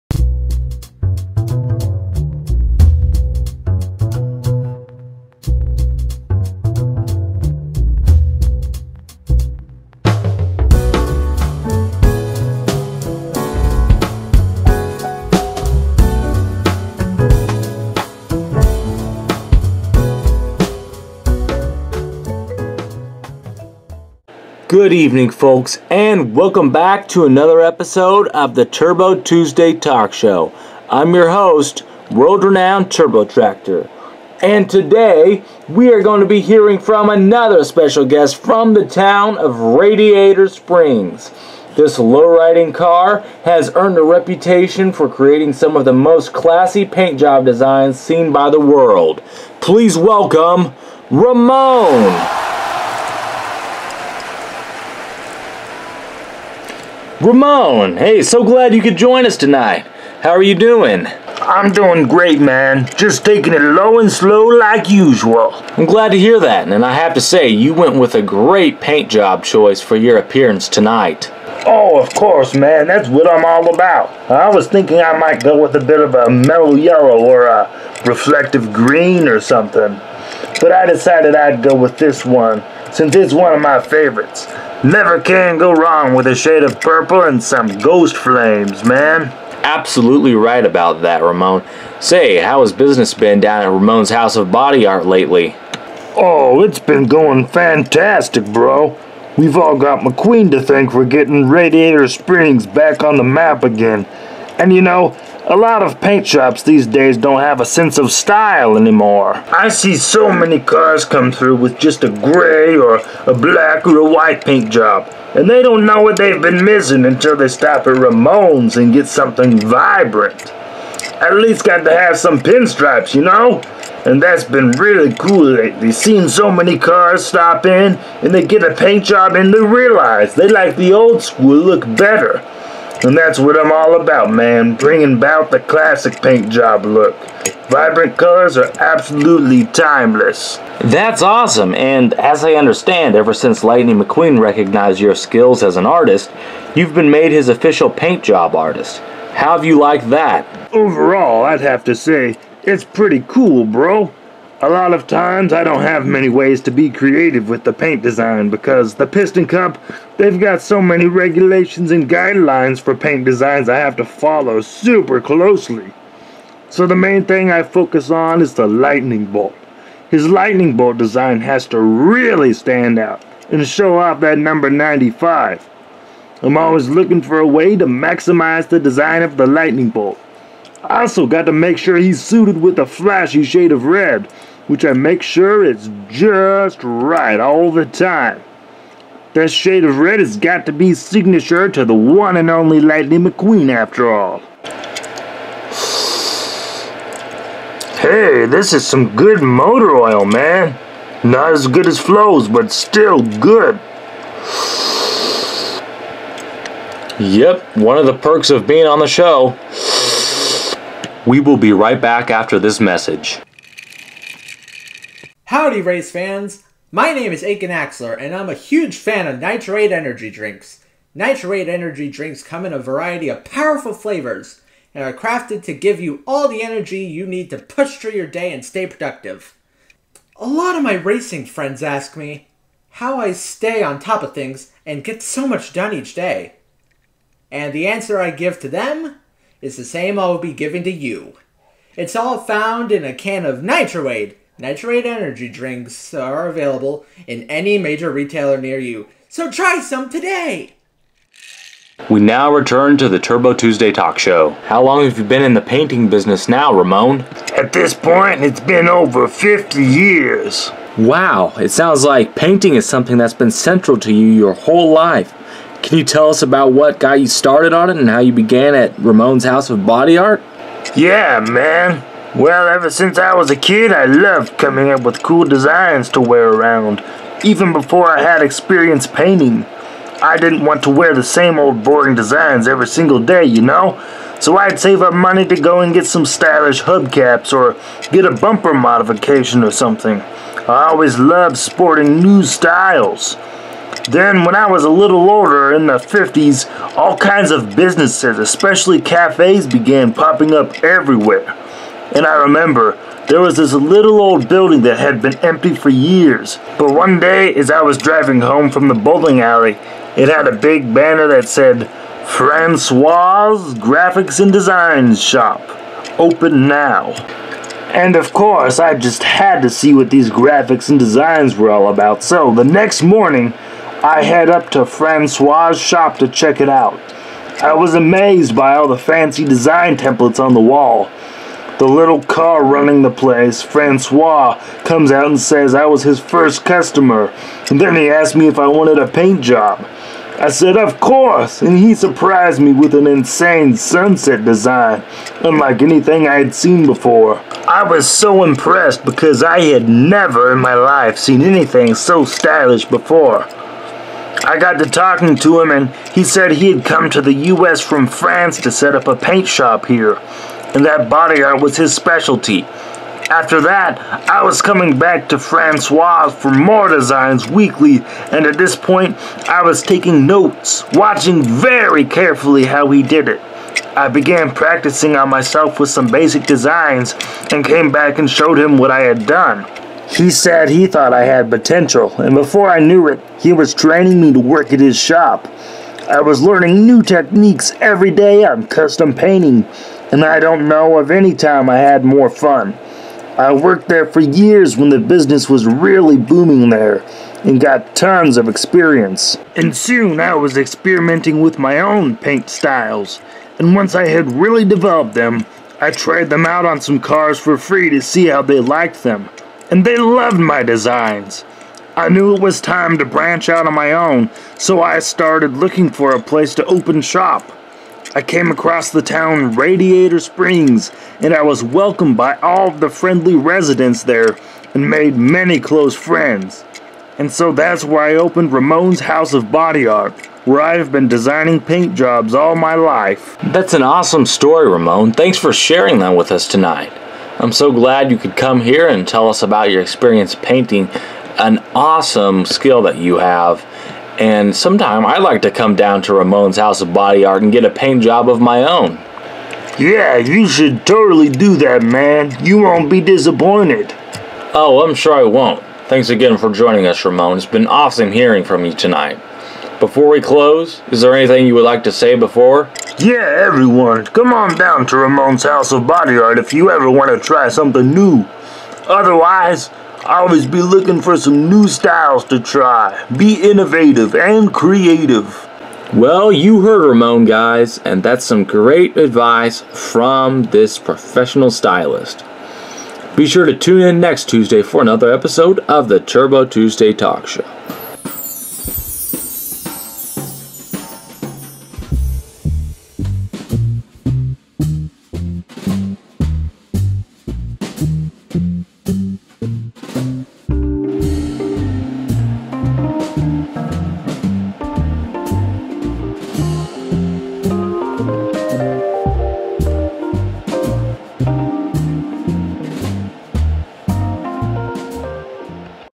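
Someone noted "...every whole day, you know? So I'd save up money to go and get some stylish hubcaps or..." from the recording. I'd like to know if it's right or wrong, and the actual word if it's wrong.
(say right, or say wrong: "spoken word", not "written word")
wrong: "single", not "whole".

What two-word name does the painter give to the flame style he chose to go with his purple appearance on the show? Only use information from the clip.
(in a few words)
ghost flames.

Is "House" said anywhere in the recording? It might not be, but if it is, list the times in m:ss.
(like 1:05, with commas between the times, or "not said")
1:34, 4:29, 7:08, 7:26, 7:45.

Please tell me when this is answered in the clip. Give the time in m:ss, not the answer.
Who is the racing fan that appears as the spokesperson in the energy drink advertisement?
3:37.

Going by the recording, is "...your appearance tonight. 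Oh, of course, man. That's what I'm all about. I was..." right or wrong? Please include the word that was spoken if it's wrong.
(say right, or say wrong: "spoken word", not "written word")
right.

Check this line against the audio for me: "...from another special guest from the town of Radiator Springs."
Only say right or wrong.
right.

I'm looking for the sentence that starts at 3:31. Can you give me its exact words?
We will be right back after this message.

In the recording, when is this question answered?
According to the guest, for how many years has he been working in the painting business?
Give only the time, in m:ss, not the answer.
4:18.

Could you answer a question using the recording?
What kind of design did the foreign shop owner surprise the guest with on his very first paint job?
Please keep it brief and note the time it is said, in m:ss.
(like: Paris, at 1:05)
sunset design, at 5:43.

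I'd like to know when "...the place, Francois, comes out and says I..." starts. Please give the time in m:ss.
5:33.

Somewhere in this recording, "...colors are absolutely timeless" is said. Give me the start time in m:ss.
2:18.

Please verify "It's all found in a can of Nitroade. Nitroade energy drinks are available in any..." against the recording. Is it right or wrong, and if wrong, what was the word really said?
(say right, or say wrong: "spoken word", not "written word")
right.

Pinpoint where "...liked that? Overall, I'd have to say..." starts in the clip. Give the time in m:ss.
2:29.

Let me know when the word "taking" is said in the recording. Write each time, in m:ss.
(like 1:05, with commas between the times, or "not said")
1:03, 6:09.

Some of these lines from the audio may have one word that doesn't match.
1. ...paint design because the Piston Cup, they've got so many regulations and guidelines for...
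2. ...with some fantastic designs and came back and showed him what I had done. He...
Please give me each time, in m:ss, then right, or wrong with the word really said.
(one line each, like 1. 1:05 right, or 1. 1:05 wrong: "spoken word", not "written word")
1. 2:37 right
2. 6:15 wrong: "basic", not "fantastic".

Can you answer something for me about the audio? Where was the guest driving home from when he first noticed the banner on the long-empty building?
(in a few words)
the bowling alley.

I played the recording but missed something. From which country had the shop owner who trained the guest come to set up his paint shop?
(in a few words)
France.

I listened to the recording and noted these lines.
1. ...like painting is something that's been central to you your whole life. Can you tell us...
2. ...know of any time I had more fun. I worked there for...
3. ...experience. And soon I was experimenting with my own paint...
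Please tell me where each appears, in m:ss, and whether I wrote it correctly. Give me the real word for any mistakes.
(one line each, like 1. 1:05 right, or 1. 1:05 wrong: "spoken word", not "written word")
1. 4:22 right
2. 6:30 right
3. 6:38 right.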